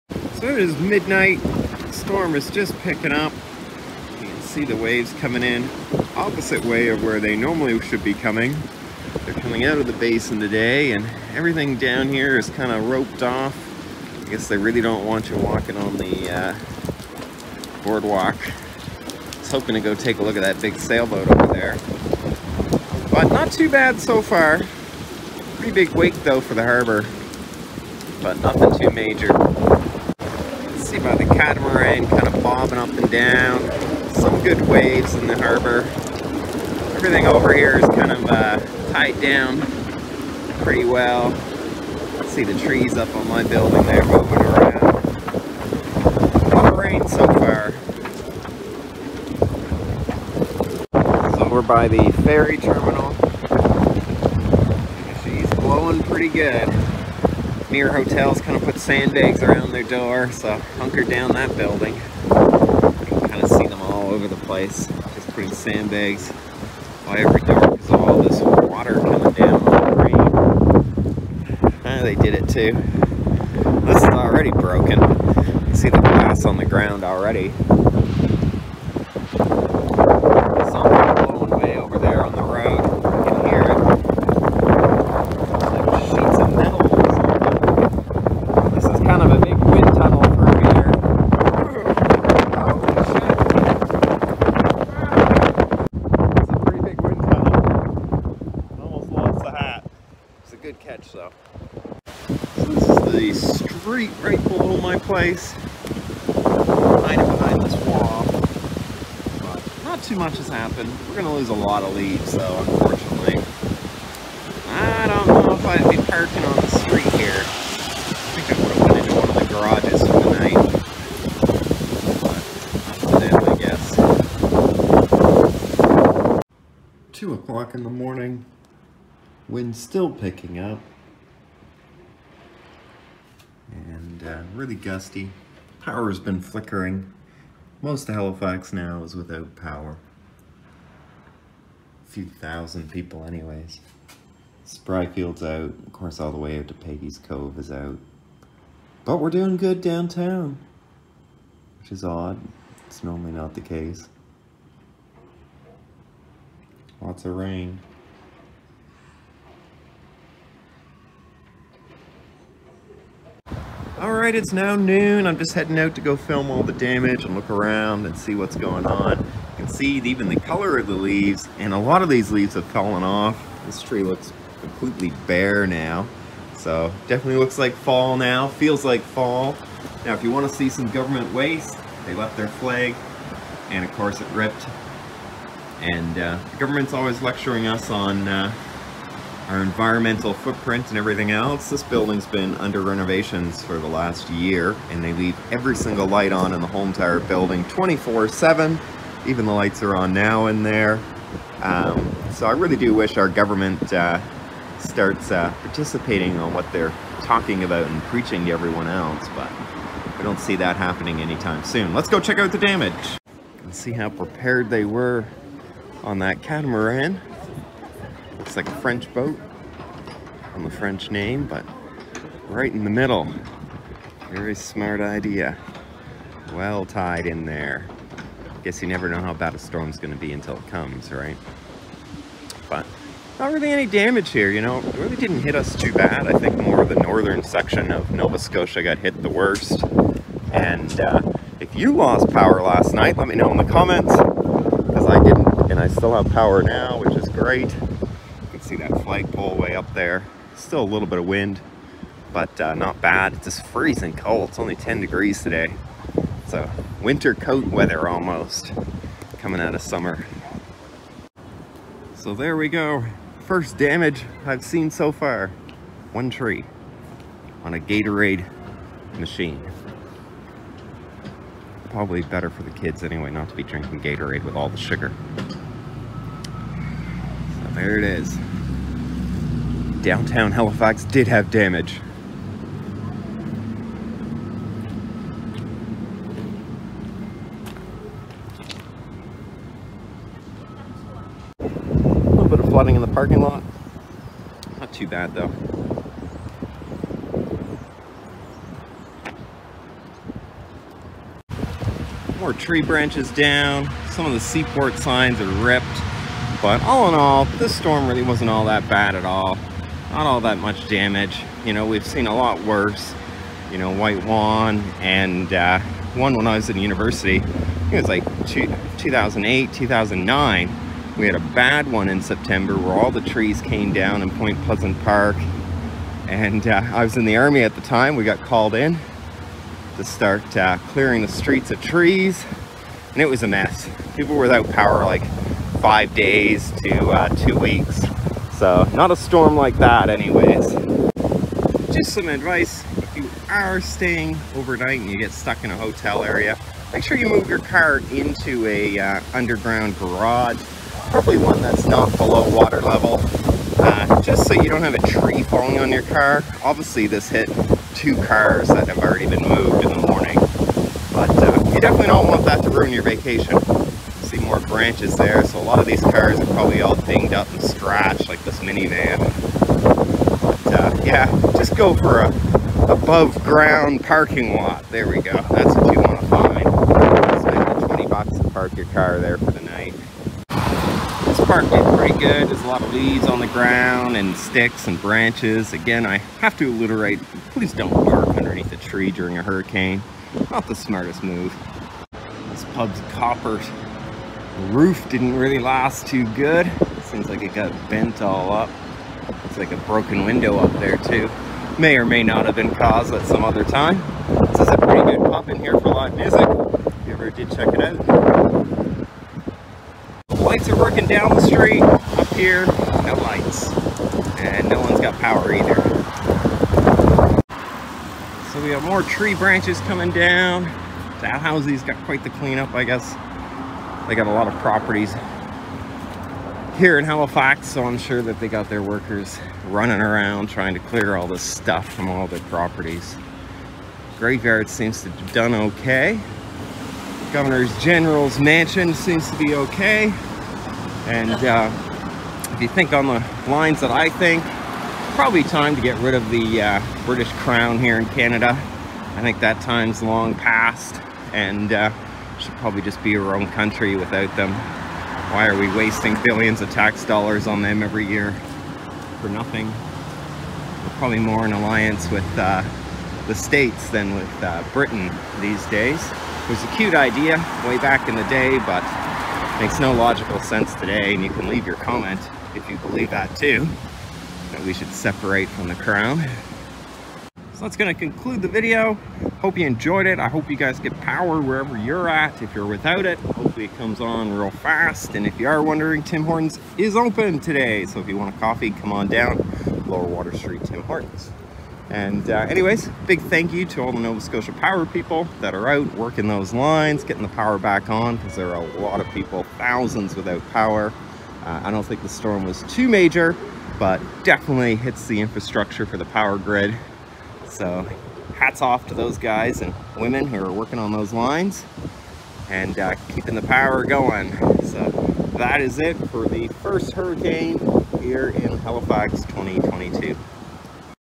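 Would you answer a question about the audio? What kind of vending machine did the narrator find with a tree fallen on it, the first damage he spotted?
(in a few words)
Gatorade machine.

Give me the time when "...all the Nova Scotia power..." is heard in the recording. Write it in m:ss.
8:13.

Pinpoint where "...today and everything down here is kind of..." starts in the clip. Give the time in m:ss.
0:10.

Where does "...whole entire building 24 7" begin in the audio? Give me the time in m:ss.
3:16.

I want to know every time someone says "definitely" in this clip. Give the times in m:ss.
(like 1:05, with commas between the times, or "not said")
2:57, 6:01, 8:24.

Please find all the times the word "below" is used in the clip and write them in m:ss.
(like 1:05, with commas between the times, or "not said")
1:44, 5:52.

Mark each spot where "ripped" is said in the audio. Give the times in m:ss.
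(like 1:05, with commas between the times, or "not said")
3:04, 5:05.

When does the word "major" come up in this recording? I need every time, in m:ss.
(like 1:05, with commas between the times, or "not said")
0:28, 8:22.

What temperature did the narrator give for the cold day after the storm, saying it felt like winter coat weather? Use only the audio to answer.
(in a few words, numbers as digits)
10 degrees.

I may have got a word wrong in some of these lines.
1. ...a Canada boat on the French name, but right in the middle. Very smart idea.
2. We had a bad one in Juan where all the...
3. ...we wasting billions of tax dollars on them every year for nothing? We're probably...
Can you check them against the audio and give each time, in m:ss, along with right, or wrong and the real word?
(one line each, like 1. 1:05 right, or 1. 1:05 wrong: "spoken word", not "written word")
1. 3:38 wrong: "French", not "Canada"
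2. 5:21 wrong: "September", not "Juan"
3. 7:35 right.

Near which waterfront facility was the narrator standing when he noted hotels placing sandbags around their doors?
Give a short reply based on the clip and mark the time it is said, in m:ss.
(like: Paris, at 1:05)
Ferry terminal, at 0:52.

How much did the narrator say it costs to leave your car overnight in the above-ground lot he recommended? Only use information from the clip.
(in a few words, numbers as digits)
$20.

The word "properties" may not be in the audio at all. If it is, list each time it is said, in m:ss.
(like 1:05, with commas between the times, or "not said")
7:04, 7:12.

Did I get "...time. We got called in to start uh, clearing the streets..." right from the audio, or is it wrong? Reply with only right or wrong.
right.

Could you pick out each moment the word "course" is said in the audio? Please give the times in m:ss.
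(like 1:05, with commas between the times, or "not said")
2:25, 3:03.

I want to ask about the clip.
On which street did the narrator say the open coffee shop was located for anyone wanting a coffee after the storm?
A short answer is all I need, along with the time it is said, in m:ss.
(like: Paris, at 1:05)
Lower Water Street, at 8:09.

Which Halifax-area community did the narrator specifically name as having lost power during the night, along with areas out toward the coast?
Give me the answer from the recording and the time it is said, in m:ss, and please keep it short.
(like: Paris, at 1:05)
Spryfield, at 2:24.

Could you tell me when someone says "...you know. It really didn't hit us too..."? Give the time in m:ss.
3:54.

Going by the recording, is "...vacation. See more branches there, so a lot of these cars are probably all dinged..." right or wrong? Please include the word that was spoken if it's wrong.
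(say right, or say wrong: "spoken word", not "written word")
right.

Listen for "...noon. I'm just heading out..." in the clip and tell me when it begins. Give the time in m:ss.
2:44.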